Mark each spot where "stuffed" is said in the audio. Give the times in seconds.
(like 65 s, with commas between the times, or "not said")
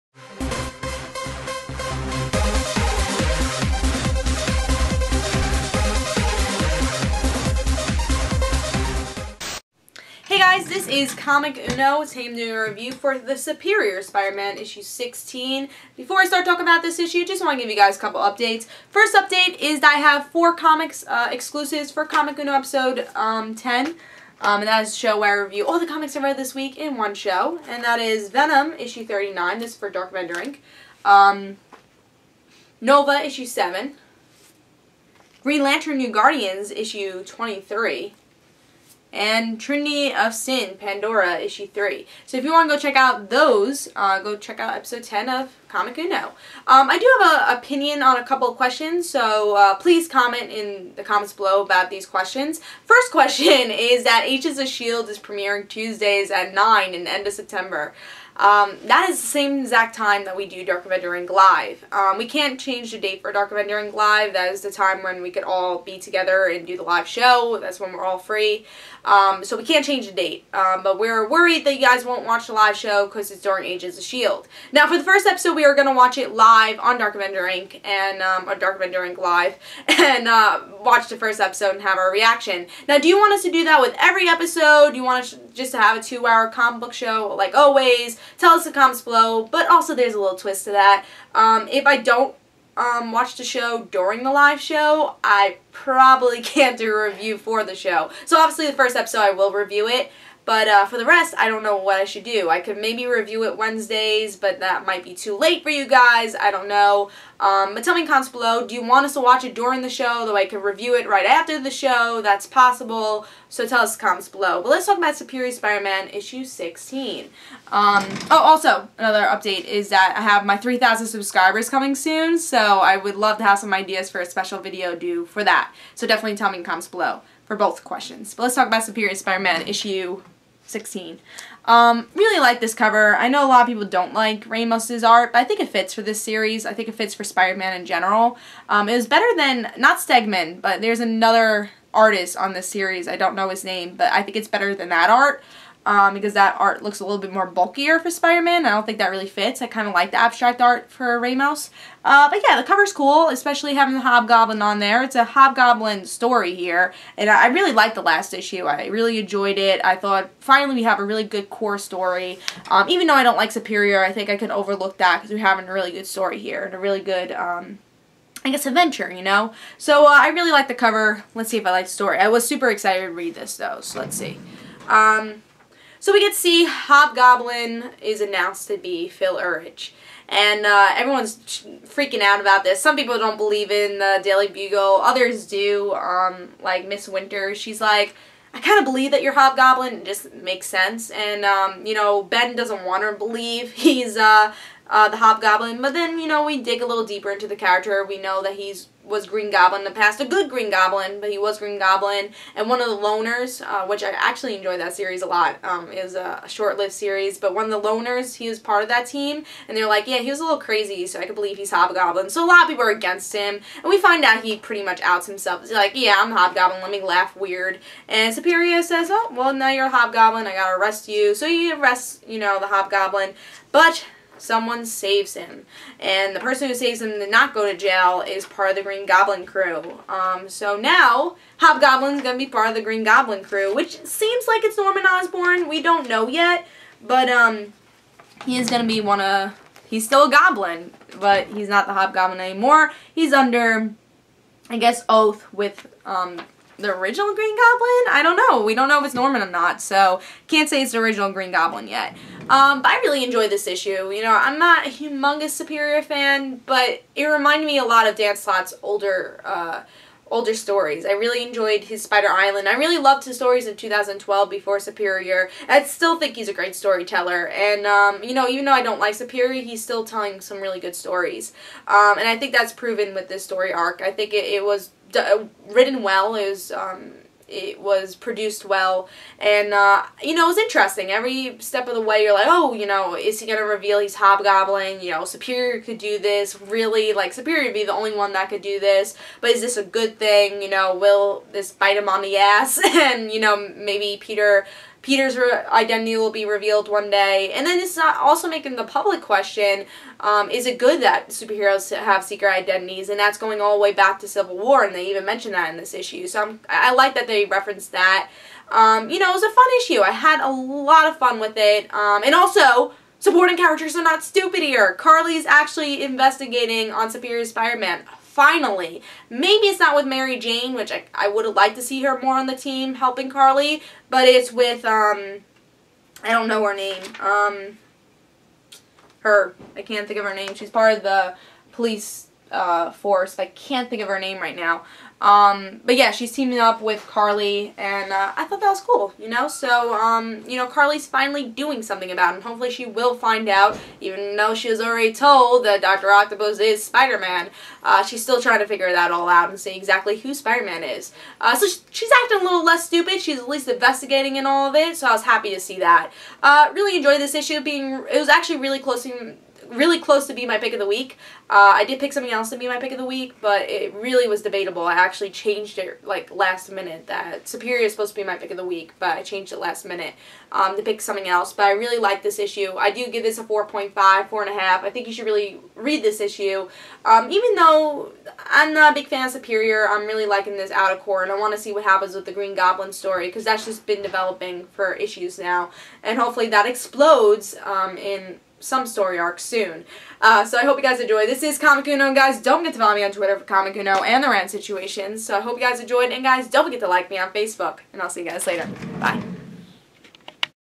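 not said.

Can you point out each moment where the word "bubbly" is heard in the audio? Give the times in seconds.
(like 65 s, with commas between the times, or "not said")
not said.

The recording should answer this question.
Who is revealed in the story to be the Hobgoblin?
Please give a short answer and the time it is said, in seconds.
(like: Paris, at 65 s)
Phil Urich, at 179 s.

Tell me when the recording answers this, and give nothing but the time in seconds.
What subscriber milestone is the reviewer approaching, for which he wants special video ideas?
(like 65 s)
120 s.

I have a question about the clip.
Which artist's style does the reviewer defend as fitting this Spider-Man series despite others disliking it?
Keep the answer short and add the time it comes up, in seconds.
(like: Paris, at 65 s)
Ramos, at 134 s.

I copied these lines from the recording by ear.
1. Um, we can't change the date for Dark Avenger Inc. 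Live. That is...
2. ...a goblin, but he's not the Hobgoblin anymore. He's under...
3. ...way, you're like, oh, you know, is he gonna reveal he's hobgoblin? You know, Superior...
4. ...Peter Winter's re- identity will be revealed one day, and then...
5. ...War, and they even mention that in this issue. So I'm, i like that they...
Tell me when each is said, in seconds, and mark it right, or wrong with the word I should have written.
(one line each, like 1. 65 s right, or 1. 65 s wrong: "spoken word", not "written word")
1. 61 s right
2. 240 s right
3. 282 s right
4. 294 s wrong: "Peter", not "Winter"
5. 304 s right.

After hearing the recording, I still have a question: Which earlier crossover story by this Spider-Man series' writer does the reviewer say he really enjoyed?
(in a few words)
Spider Island.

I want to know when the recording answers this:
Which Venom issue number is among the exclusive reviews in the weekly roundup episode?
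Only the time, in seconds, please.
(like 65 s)
28 s.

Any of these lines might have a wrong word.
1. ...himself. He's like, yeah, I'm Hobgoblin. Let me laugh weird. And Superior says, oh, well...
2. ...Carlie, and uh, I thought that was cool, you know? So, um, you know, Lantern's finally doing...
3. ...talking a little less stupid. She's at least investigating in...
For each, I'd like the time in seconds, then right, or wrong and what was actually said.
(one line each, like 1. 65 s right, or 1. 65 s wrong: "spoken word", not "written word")
1. 215 s right
2. 337 s wrong: "Carlie", not "Lantern"
3. 352 s wrong: "acting", not "talking".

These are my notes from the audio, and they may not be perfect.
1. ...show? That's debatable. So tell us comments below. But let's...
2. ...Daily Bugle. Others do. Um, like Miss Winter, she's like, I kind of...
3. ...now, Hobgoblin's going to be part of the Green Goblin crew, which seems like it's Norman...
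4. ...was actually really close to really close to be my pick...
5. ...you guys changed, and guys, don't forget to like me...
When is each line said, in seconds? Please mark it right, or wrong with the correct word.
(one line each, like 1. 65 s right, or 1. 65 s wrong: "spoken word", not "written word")
1. 111 s wrong: "possible", not "debatable"
2. 184 s right
3. 230 s right
4. 358 s right
5. 395 s wrong: "enjoyed", not "changed".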